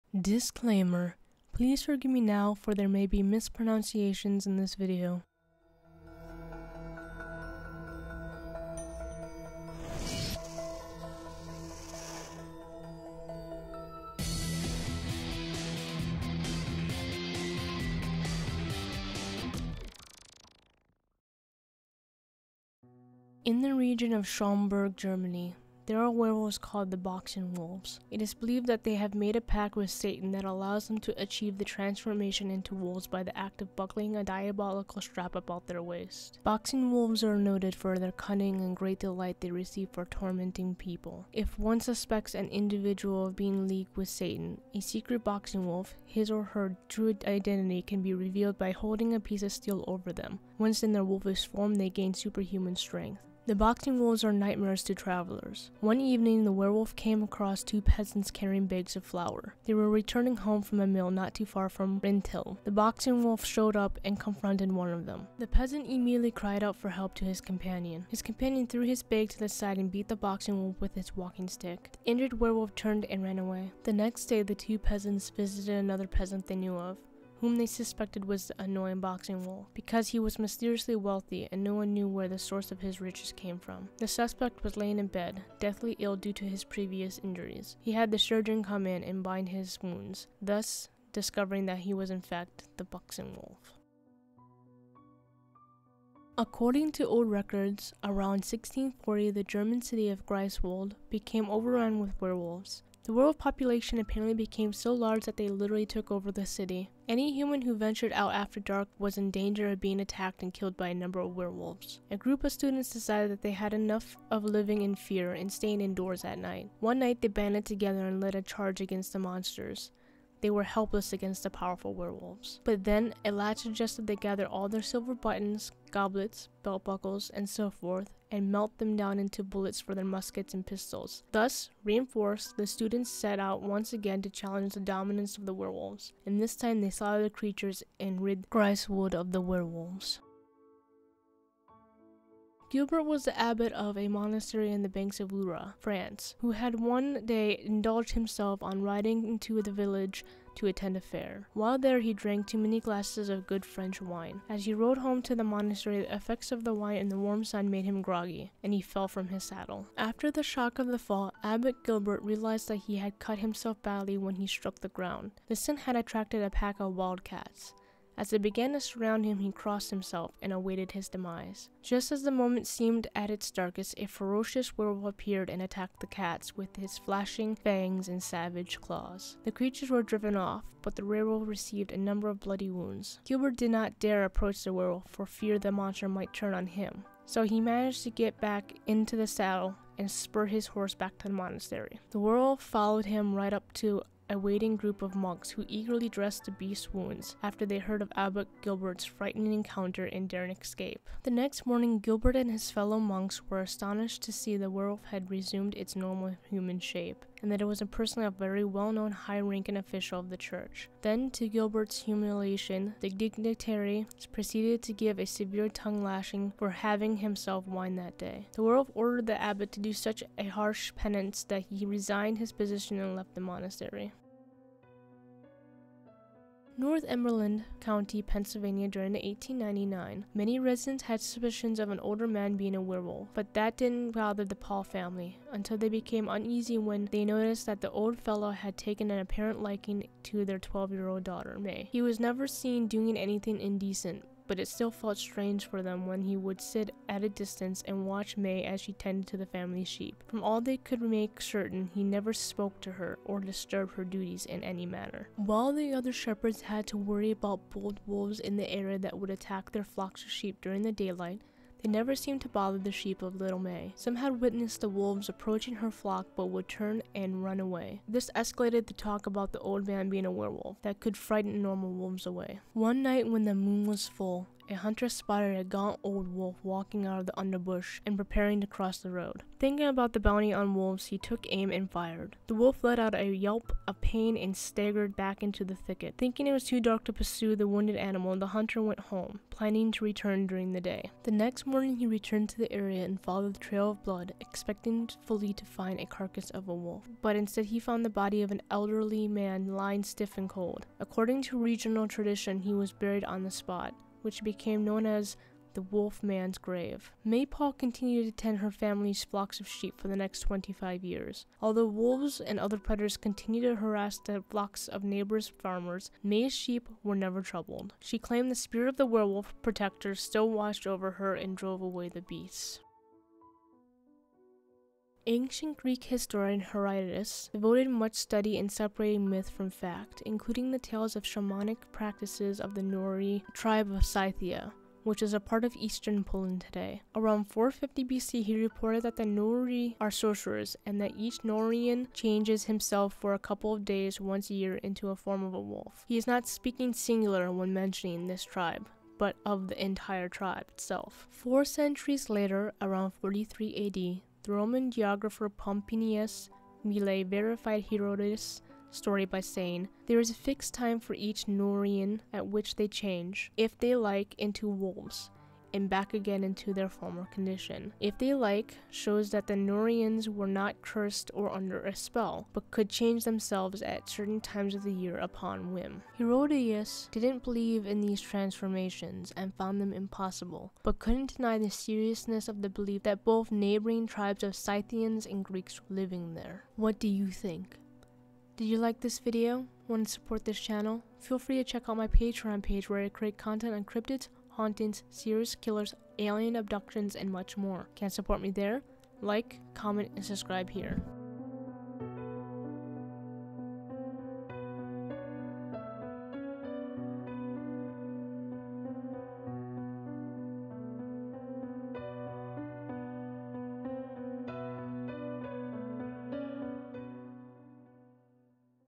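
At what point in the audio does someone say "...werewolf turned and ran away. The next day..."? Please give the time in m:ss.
1:12.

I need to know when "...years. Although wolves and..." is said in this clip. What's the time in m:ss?
5:11.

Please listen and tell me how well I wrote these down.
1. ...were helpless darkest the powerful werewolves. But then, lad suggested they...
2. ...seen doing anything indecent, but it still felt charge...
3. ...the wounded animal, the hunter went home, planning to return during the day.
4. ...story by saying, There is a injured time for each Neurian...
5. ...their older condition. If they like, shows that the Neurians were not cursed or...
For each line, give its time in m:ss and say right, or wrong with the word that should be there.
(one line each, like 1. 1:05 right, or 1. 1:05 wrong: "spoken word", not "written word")
1. 2:00 wrong: "against", not "darkest"
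2. 4:02 wrong: "strange", not "charge"
3. 4:47 right
4. 5:58 wrong: "fixed", not "injured"
5. 6:06 wrong: "former", not "older".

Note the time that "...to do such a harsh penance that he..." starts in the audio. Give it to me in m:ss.
3:39.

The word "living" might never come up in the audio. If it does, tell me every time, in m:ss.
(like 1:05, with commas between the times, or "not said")
1:54, 6:25.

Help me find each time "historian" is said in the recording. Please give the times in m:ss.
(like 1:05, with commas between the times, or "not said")
5:26.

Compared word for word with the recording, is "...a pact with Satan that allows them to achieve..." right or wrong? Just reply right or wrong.
right.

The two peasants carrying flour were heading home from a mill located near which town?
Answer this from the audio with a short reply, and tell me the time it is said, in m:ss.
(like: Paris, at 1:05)
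Rinteln, at 1:02.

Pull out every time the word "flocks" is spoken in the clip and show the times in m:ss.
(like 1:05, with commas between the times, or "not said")
4:19, 4:25, 5:09, 5:14.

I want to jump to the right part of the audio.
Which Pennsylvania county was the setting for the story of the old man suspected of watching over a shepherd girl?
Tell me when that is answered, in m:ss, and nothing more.
3:46.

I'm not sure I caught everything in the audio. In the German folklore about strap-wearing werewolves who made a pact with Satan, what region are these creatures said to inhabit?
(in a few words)
Schaumburg.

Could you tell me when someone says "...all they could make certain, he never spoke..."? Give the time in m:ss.
4:10.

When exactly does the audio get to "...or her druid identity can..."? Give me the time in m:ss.
0:46.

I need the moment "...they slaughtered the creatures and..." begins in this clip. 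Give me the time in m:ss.
2:16.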